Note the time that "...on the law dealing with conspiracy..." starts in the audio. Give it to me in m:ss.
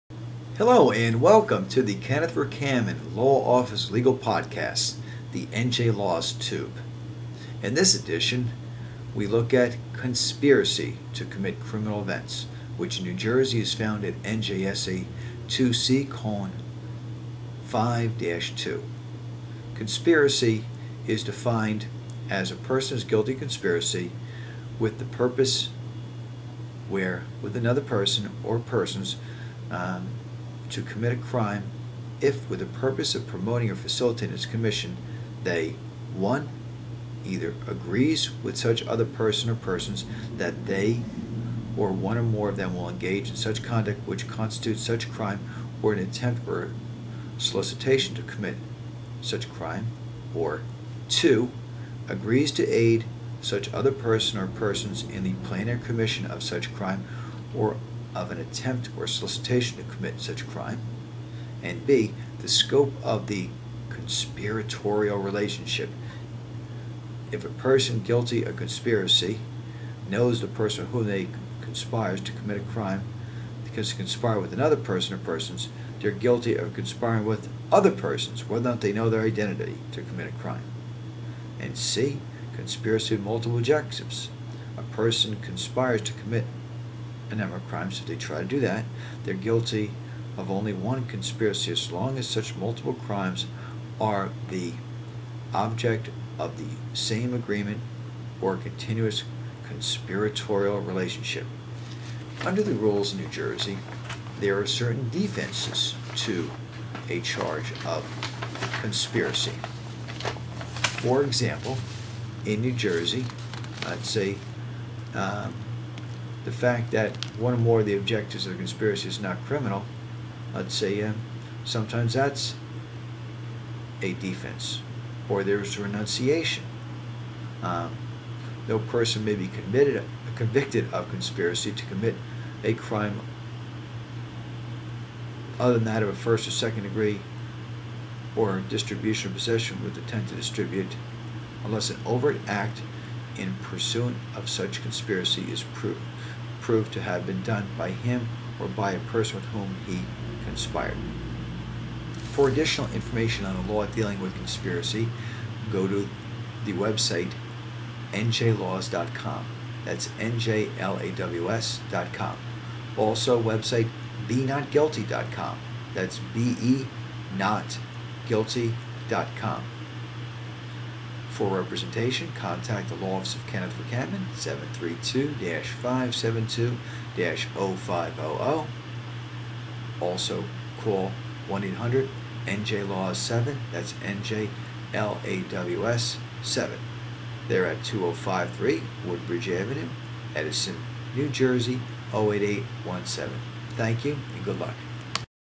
2:33.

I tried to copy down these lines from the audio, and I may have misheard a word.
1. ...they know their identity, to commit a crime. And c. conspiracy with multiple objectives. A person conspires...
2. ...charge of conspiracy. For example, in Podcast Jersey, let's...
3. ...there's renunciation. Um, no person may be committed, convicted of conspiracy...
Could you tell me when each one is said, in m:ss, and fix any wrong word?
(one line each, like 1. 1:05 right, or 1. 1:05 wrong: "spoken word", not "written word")
1. 1:18 right
2. 1:47 wrong: "New", not "Podcast"
3. 2:05 right.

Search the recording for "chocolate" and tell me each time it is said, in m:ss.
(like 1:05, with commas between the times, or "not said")
not said.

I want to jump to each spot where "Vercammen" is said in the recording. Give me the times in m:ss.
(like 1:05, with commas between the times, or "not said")
0:02, 2:53.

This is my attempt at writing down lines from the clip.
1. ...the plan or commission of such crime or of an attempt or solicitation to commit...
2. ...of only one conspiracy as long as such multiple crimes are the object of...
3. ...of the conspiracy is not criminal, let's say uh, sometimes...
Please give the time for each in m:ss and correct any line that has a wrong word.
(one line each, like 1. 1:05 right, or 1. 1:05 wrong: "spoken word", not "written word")
1. 0:55 right
2. 1:30 right
3. 1:58 right.